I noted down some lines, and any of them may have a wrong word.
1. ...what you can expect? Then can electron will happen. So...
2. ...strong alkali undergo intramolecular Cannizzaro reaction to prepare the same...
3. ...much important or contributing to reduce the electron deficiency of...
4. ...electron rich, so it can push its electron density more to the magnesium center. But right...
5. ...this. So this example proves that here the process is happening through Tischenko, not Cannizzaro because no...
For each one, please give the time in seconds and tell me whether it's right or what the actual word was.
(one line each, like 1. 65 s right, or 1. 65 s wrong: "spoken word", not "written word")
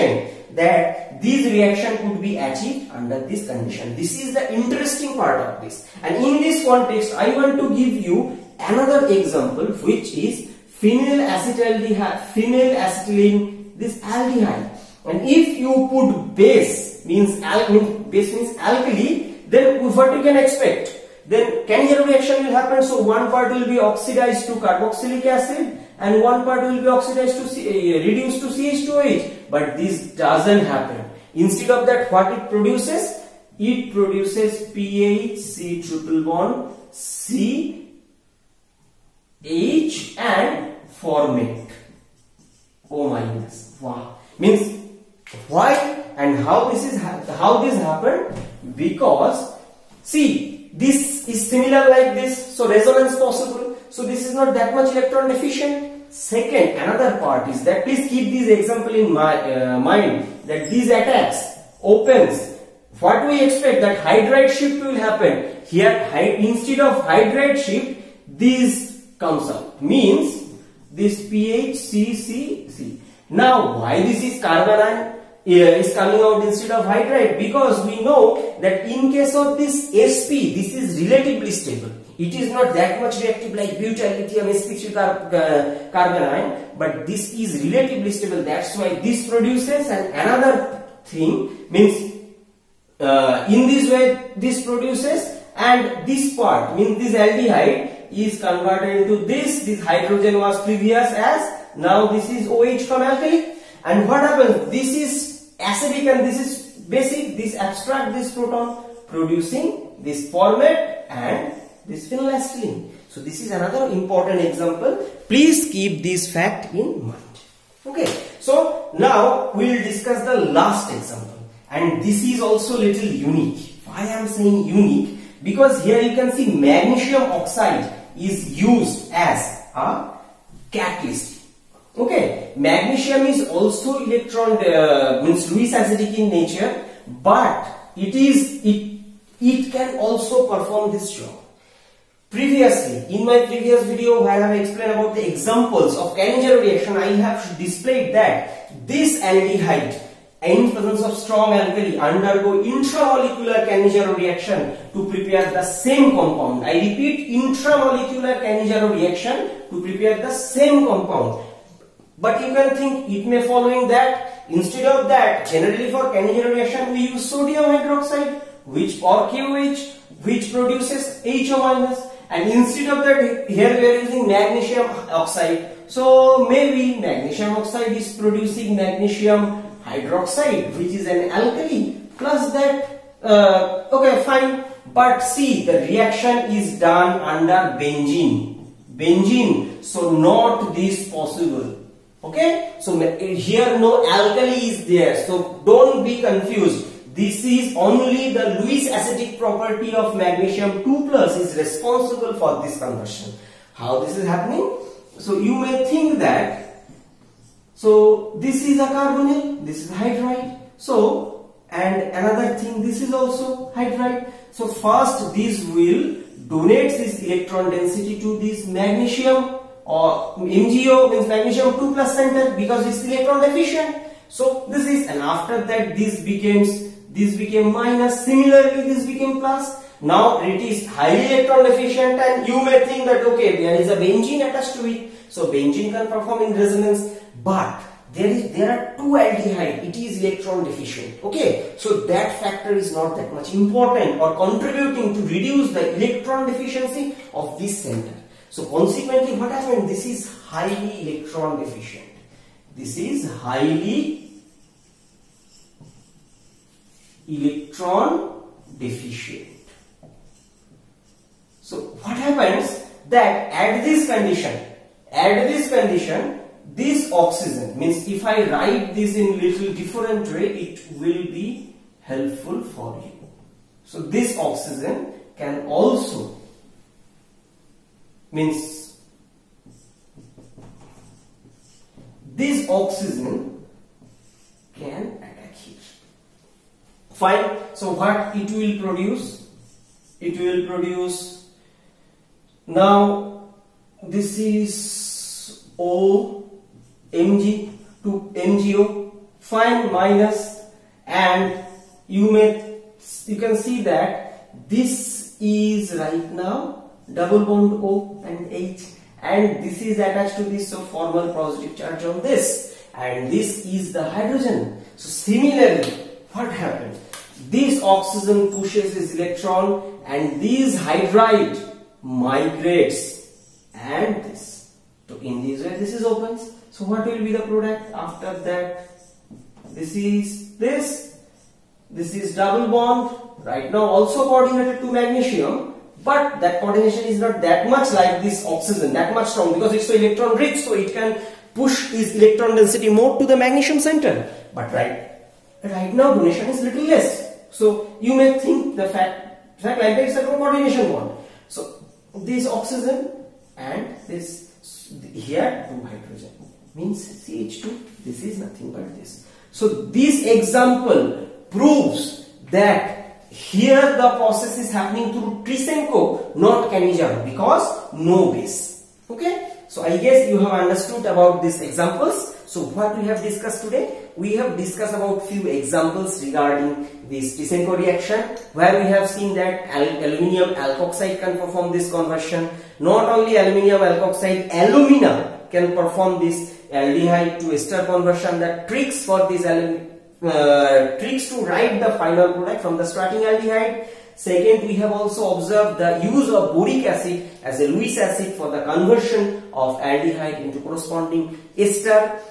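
1. 19 s wrong: "reaction", not "electron"
2. 151 s right
3. 243 s right
4. 339 s right
5. 358 s right.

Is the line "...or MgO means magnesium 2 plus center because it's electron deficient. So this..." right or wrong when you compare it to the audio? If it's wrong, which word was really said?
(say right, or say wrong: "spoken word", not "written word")
right.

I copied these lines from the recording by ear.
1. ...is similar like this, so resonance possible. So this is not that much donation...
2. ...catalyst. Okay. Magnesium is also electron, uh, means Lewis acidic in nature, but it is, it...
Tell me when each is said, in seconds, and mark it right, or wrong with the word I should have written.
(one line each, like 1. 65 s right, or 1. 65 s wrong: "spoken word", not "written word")
1. 51 s wrong: "electron", not "donation"
2. 130 s right.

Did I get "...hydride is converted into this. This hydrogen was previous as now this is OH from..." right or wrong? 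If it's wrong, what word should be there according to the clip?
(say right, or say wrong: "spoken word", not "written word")
wrong: "aldehyde", not "hydride".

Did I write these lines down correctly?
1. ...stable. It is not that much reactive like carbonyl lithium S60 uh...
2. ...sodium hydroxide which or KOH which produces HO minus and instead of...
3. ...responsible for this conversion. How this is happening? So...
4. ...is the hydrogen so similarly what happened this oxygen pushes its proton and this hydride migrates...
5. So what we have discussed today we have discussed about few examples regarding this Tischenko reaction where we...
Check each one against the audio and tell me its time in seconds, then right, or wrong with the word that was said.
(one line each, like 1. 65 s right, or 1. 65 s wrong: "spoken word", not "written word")
1. 81 s wrong: "butyl", not "carbonyl"
2. 167 s right
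3. 201 s right
4. 313 s wrong: "electron", not "proton"
5. 372 s right.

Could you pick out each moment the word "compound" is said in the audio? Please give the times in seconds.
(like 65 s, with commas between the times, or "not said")
156 s, 160 s.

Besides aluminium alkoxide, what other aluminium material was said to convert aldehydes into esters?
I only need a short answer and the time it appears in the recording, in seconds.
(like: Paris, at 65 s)
alumina, at 384 s.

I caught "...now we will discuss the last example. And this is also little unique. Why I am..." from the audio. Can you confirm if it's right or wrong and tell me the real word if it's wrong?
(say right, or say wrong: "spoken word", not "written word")
right.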